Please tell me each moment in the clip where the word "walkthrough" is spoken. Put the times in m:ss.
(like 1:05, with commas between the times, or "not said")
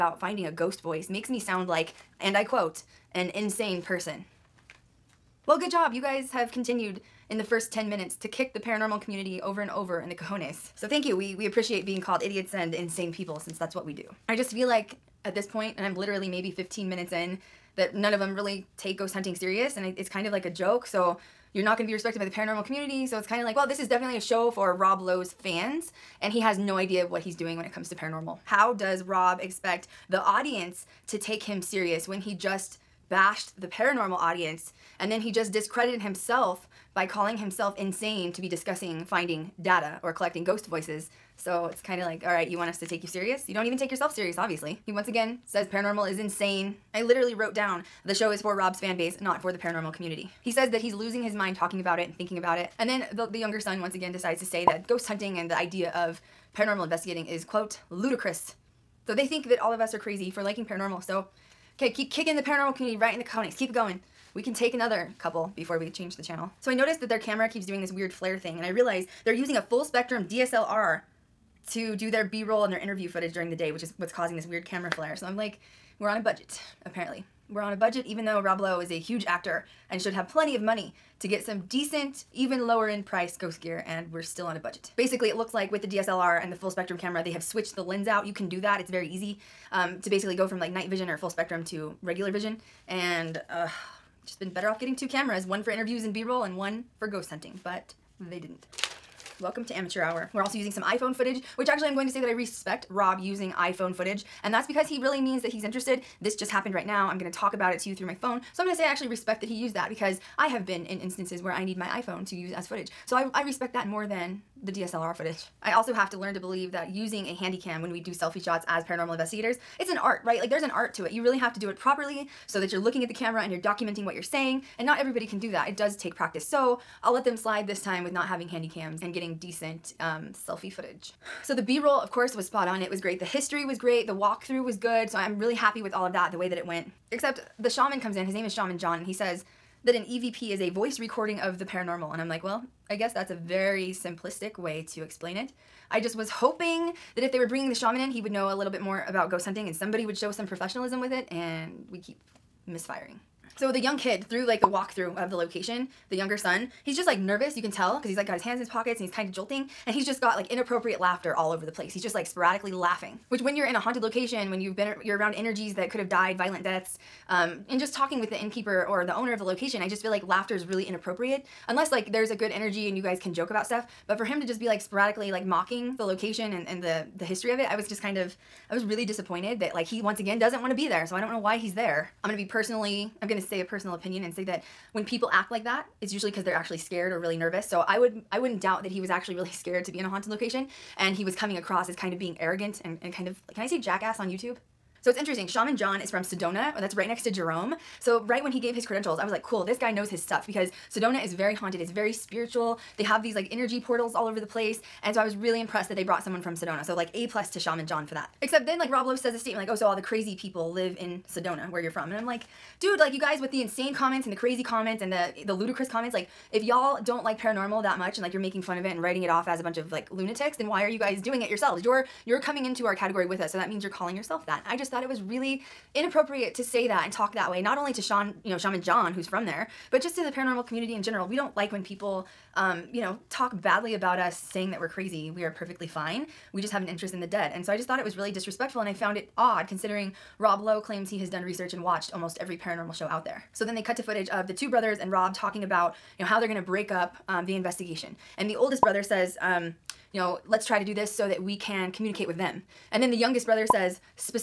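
2:14, 2:34.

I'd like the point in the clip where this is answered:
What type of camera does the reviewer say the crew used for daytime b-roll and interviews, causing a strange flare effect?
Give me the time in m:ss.
1:09.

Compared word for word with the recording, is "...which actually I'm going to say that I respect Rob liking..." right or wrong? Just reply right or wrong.
wrong.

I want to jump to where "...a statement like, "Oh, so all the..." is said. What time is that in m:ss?
3:29.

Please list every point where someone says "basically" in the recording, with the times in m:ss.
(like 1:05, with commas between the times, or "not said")
1:24, 1:30.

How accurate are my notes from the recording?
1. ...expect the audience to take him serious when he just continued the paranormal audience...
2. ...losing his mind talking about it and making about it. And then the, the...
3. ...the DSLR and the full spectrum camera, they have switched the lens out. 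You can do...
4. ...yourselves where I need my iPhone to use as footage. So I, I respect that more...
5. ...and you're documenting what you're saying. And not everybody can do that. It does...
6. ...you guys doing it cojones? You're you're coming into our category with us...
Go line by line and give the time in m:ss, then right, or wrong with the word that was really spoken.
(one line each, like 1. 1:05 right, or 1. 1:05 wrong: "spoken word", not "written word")
1. 0:29 wrong: "bashed", not "continued"
2. 0:50 wrong: "thinking", not "making"
3. 1:25 right
4. 1:50 wrong: "instances", not "yourselves"
5. 2:03 right
6. 3:40 wrong: "yourselves", not "cojones".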